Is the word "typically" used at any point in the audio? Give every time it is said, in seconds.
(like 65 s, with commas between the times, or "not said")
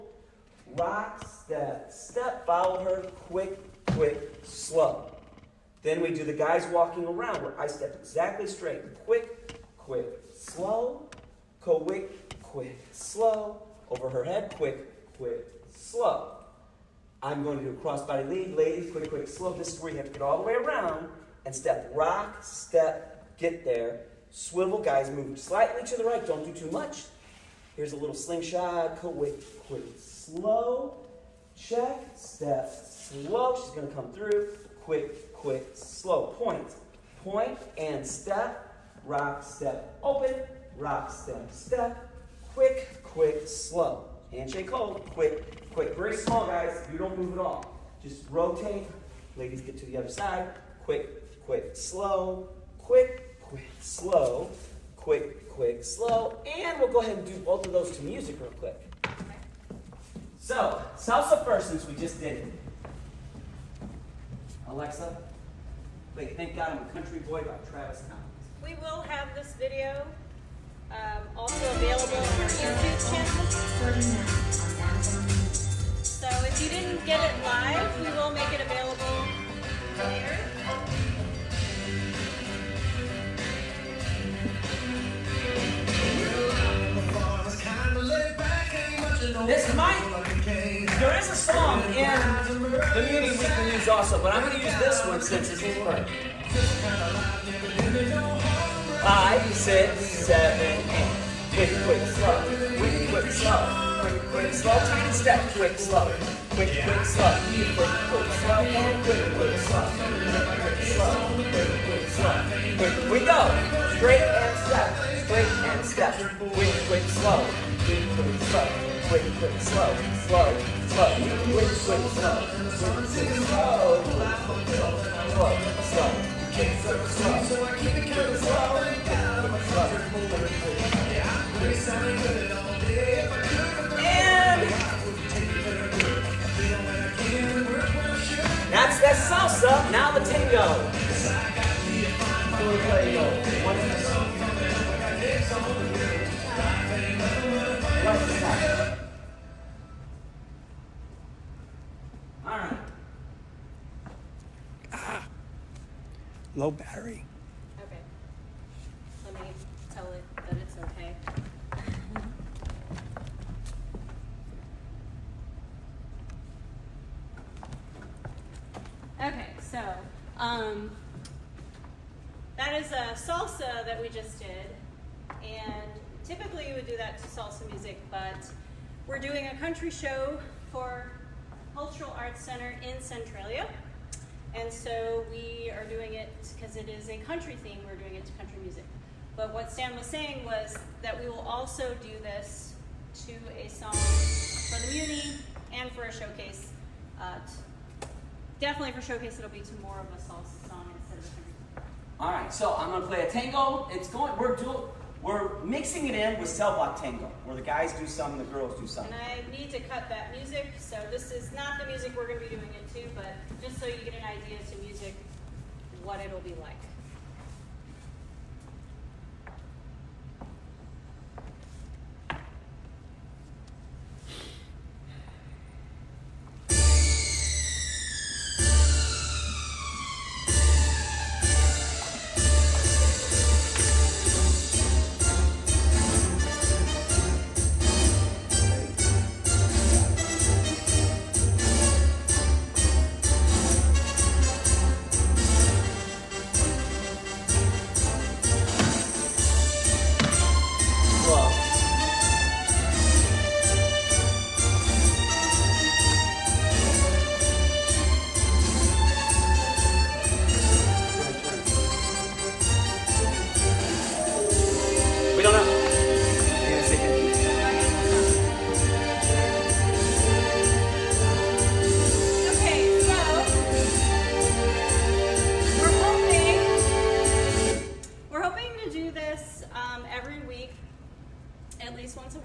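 176 s.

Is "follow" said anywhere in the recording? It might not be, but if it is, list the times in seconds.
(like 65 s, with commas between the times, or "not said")
2 s.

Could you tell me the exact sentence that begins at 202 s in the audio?
All right, so I'm gonna play a tango.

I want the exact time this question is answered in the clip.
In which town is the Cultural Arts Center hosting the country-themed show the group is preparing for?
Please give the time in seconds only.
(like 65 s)
183 s.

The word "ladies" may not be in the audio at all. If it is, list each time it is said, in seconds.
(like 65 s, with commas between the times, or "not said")
18 s, 49 s.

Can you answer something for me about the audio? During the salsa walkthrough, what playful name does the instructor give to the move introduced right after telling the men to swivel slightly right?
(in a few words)
slingshot.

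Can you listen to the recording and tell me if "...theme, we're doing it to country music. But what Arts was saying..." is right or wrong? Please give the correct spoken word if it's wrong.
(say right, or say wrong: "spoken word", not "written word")
wrong: "Stan", not "Arts".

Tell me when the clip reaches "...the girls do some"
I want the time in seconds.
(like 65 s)
208 s.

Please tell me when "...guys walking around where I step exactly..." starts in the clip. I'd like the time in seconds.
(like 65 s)
6 s.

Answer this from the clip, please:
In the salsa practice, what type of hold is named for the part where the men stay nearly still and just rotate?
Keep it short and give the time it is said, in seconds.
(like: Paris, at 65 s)
Handshake hold, at 44 s.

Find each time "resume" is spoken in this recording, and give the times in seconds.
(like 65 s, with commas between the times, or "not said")
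not said.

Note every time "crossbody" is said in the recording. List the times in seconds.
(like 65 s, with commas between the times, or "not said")
17 s.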